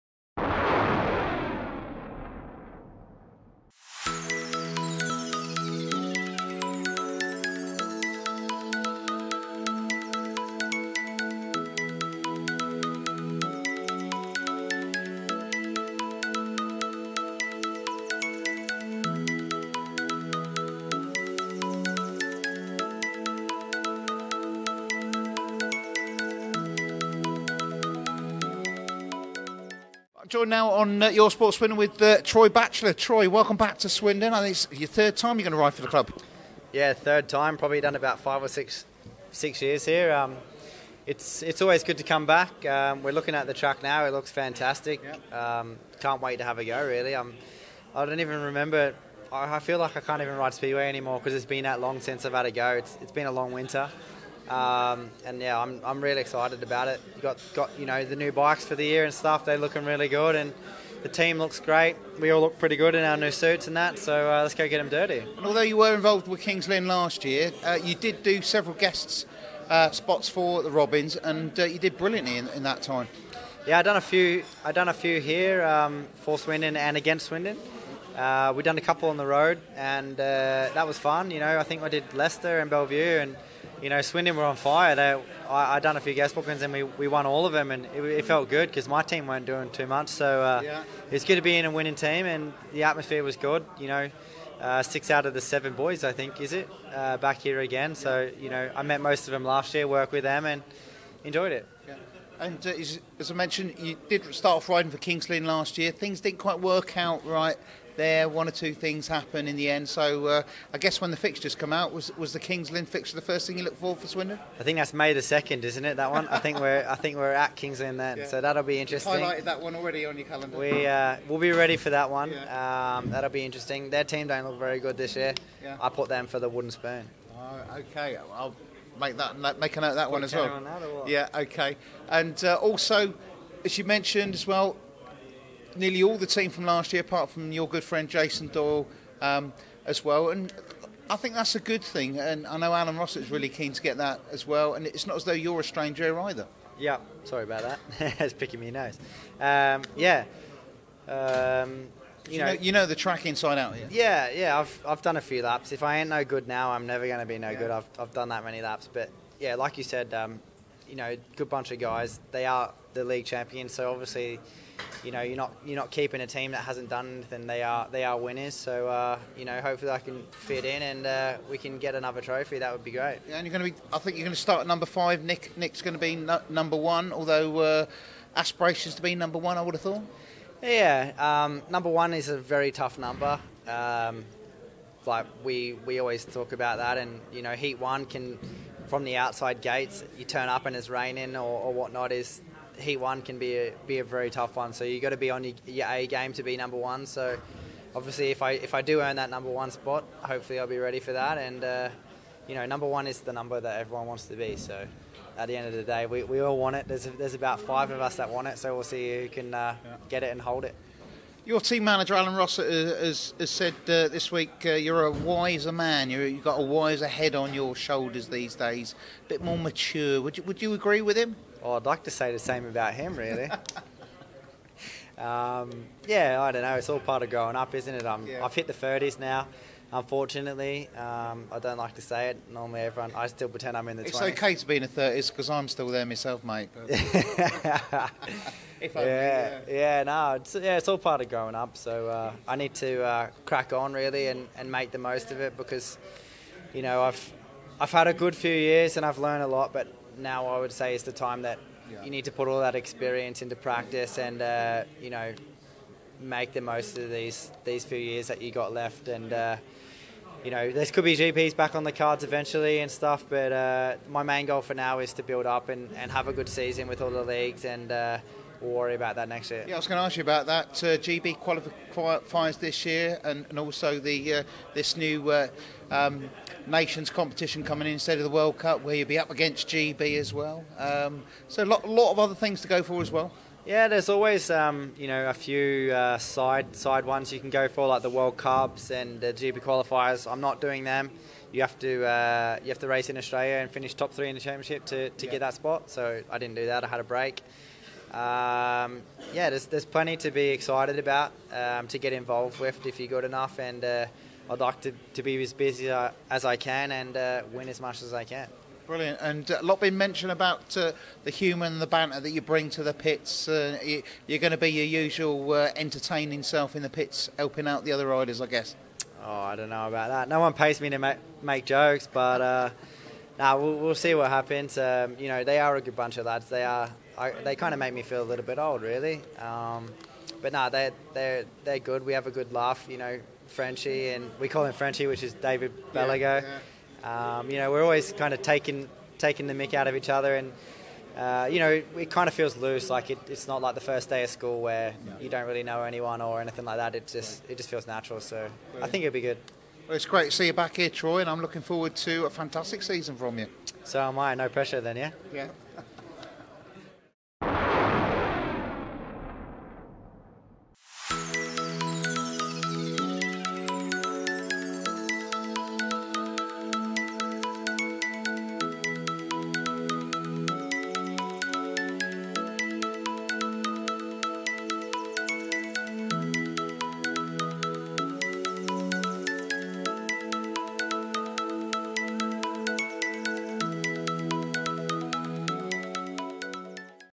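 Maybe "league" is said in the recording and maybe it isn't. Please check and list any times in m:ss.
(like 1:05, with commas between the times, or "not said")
2:43, 4:27.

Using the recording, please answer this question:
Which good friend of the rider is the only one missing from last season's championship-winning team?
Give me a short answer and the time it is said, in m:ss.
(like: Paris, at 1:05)
Jason Doyle, at 2:18.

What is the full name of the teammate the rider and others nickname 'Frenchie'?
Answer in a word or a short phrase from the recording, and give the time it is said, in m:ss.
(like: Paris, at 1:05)
David Bellego, at 5:35.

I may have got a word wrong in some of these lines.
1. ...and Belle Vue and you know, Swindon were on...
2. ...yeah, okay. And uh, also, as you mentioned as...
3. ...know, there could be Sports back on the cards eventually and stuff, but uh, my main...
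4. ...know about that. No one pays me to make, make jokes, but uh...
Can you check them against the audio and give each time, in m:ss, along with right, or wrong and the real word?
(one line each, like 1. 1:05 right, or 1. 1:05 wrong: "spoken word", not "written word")
1. 1:22 right
2. 2:11 right
3. 4:20 wrong: "GPs", not "Sports"
4. 5:19 right.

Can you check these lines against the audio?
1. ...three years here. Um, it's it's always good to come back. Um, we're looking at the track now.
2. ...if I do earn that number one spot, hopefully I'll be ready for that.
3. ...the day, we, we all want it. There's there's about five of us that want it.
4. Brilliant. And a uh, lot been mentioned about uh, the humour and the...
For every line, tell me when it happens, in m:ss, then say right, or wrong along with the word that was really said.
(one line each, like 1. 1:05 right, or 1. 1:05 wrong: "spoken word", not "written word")
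1. 0:39 wrong: "six", not "three"
2. 3:18 right
3. 3:25 right
4. 5:08 right.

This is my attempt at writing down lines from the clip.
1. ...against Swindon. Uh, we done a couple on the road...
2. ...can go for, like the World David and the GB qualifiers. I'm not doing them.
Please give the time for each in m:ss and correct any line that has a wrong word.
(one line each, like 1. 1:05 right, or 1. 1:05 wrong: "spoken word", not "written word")
1. 1:16 right
2. 4:47 wrong: "Cups", not "David".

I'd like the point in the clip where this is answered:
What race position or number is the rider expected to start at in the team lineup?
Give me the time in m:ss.
2:54.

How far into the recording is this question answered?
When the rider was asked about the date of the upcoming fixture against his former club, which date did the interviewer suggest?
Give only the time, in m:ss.
1:54.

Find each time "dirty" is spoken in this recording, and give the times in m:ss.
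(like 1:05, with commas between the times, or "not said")
1:04.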